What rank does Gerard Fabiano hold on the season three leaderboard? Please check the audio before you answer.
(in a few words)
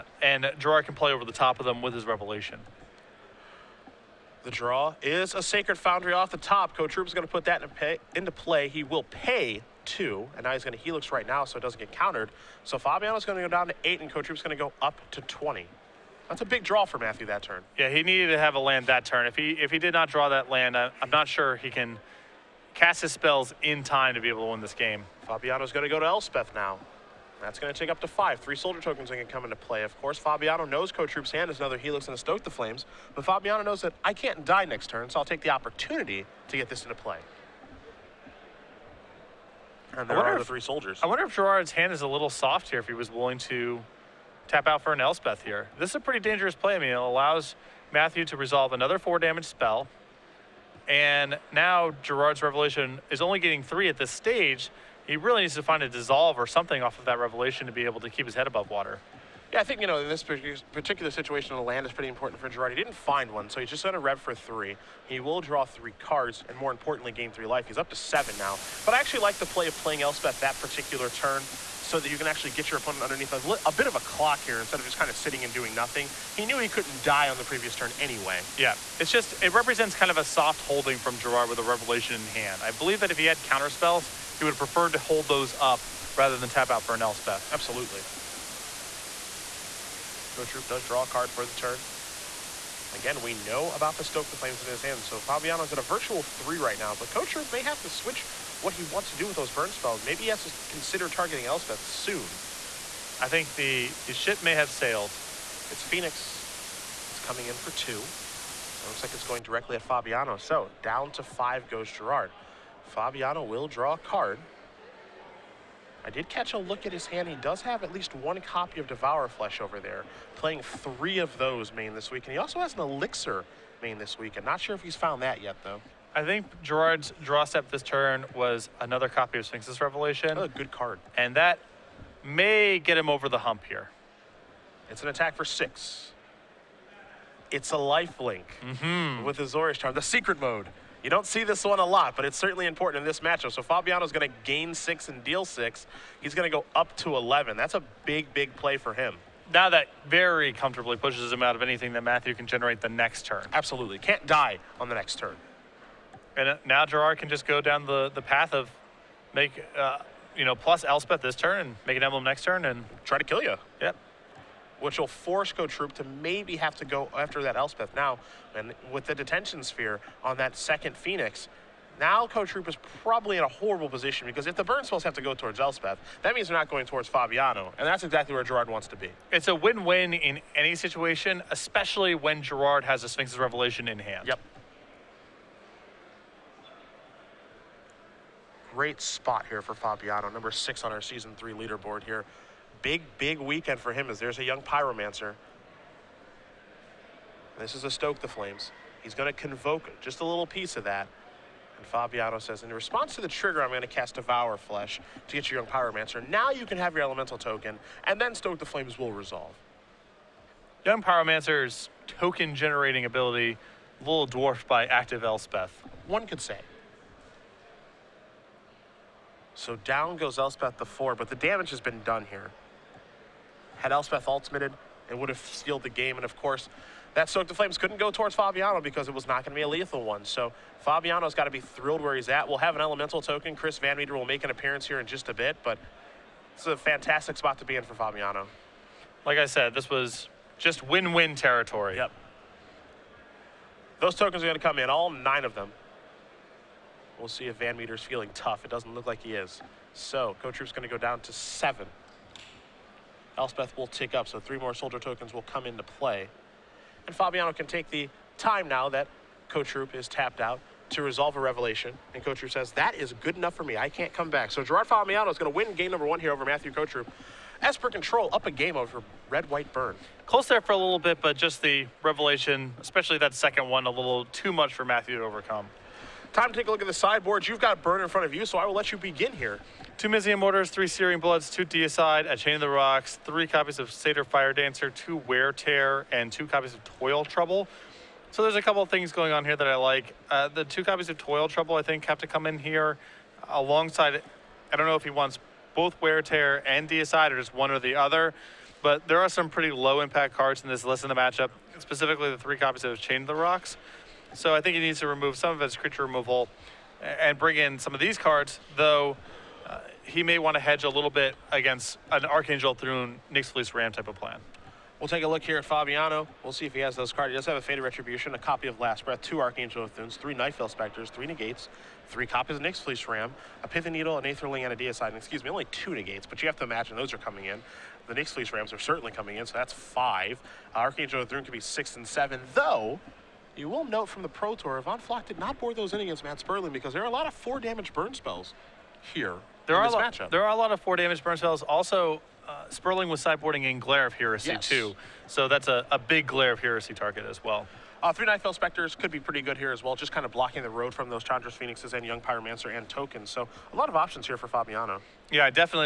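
6.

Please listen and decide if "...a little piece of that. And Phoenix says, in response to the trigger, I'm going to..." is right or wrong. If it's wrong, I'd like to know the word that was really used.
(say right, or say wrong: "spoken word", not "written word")
wrong: "Fabiano", not "Phoenix".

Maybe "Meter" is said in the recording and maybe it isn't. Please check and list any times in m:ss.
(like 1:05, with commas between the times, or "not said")
3:53, 4:07.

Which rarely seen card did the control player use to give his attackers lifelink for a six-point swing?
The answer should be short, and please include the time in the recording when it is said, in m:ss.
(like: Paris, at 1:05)
Azorius Charm, at 2:19.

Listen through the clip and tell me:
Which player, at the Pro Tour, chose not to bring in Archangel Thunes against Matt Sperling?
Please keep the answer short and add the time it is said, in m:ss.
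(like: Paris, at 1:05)
Ivan Floch, at 5:34.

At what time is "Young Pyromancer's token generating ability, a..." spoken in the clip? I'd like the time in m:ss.
3:30.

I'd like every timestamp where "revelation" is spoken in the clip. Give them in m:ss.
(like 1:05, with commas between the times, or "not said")
0:02, 0:52, 0:57, 1:21, 2:09, 3:03, 4:21, 4:32.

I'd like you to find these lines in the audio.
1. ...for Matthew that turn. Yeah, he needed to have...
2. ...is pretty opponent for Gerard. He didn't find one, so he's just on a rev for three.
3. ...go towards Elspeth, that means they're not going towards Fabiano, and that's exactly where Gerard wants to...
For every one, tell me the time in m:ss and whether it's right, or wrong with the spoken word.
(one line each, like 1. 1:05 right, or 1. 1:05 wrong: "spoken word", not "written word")
1. 0:16 right
2. 1:01 wrong: "important", not "opponent"
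3. 2:55 right.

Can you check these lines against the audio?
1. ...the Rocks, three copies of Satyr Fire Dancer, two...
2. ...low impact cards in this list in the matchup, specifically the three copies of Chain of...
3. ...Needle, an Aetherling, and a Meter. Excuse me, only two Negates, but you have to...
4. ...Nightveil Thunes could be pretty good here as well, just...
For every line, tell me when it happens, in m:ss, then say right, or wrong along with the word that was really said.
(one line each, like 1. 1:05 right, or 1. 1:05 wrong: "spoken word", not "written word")
1. 4:42 right
2. 4:59 right
3. 5:23 wrong: "Deicide", not "Meter"
4. 5:48 wrong: "Spectres", not "Thunes".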